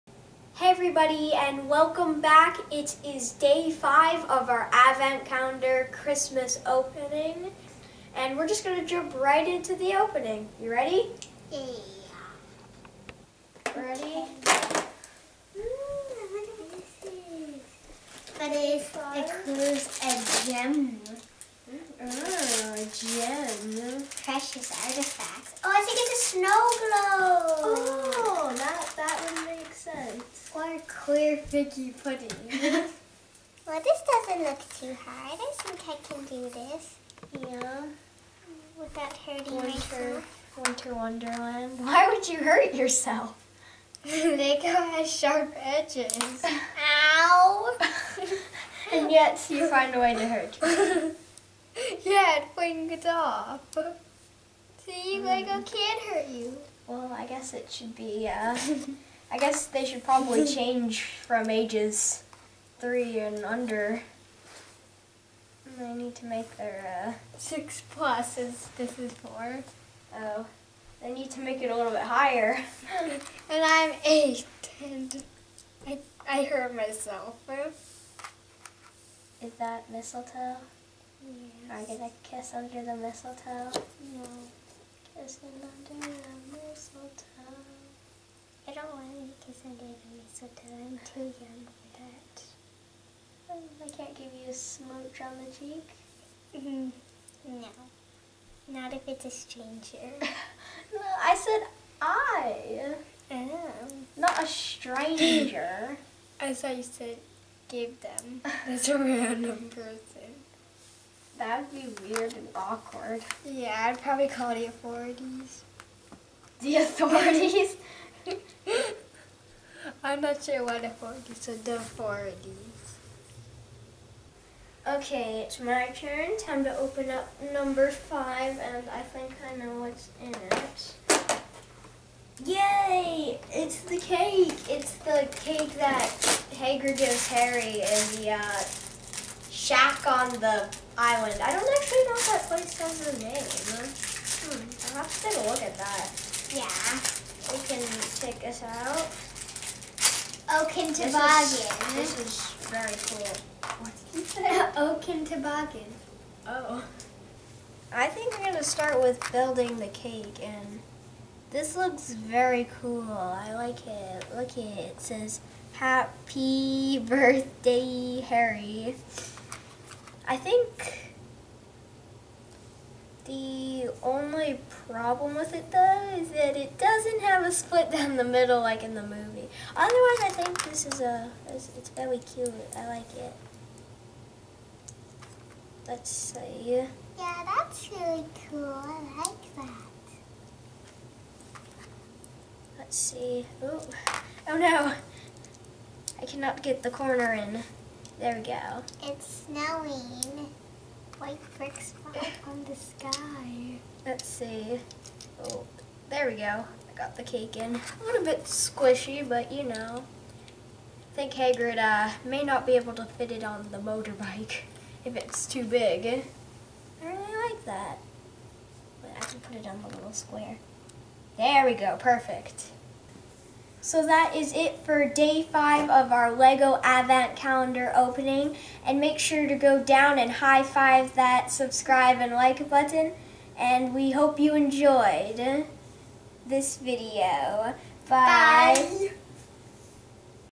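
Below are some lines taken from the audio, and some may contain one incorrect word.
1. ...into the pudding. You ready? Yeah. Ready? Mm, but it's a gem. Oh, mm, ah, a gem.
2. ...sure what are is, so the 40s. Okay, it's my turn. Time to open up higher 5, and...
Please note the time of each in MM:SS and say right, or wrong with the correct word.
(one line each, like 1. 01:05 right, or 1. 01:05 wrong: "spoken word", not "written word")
1. 00:09 wrong: "opening", not "pudding"
2. 02:00 wrong: "number", not "higher".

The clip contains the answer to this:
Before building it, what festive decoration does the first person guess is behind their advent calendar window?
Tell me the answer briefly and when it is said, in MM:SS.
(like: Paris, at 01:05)
Snow globe, at 00:26.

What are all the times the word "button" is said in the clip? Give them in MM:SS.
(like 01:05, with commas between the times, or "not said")
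03:52.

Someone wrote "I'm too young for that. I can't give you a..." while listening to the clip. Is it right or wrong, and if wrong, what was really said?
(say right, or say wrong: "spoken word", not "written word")
right.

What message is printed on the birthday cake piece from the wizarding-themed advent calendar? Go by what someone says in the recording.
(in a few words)
Happy birthday Harry.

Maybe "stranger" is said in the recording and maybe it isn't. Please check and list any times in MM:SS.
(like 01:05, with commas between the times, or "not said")
01:39, 01:44.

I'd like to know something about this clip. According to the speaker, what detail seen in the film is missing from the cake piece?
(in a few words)
A split down the middle.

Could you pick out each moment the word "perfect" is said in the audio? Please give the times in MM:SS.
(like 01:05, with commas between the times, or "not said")
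03:41.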